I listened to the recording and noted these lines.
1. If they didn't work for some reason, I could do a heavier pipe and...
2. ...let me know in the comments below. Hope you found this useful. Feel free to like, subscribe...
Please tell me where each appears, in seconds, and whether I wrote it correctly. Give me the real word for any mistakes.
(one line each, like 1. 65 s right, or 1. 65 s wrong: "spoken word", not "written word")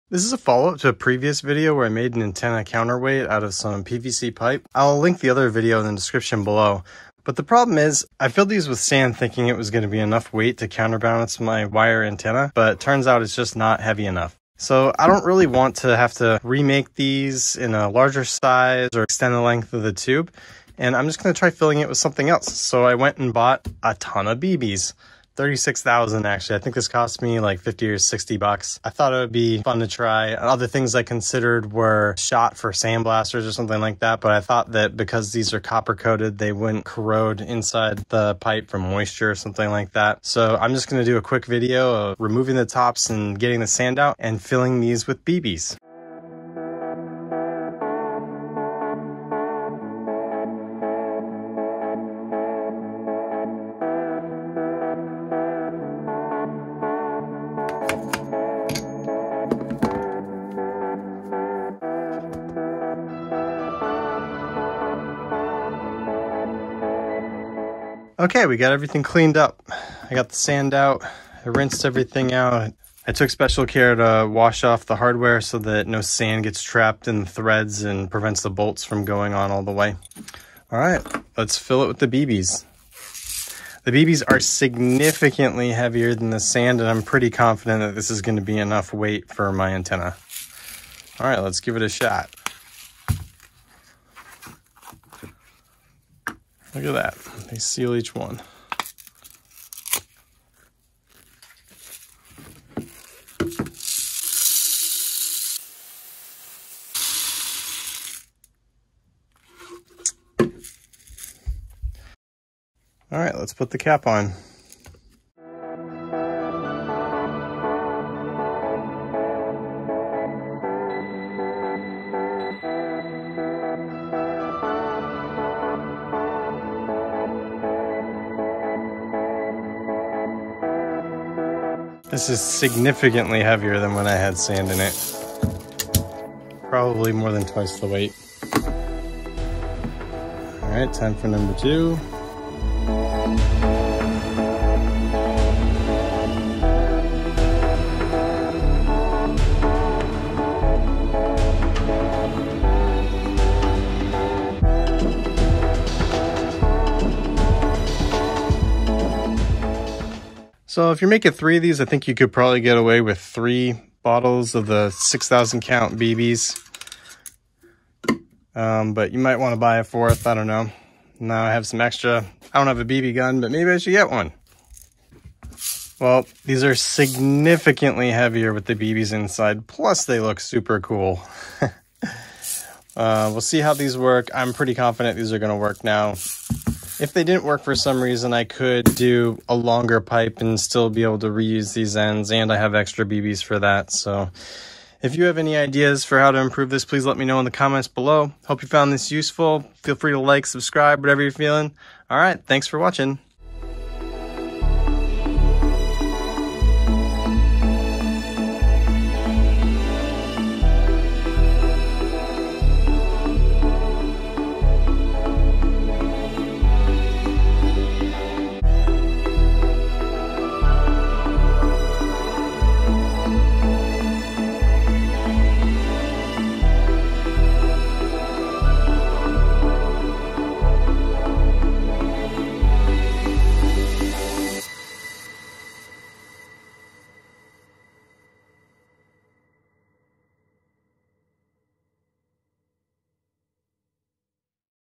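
1. 187 s wrong: "longer", not "heavier"
2. 197 s right.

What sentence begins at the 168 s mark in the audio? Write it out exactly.
Um, but you might want to buy a fourth.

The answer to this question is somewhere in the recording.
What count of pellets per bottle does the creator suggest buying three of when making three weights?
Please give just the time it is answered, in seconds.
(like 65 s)
164 s.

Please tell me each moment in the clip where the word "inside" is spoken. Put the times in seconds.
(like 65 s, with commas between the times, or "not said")
37 s, 179 s.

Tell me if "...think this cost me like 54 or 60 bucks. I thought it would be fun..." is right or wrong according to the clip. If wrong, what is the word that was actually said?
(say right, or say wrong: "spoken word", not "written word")
wrong: "50", not "54".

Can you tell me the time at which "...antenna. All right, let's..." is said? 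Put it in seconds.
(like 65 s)
89 s.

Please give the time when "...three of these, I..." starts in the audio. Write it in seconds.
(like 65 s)
161 s.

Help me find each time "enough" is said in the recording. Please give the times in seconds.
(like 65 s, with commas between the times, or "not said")
9 s, 14 s, 88 s.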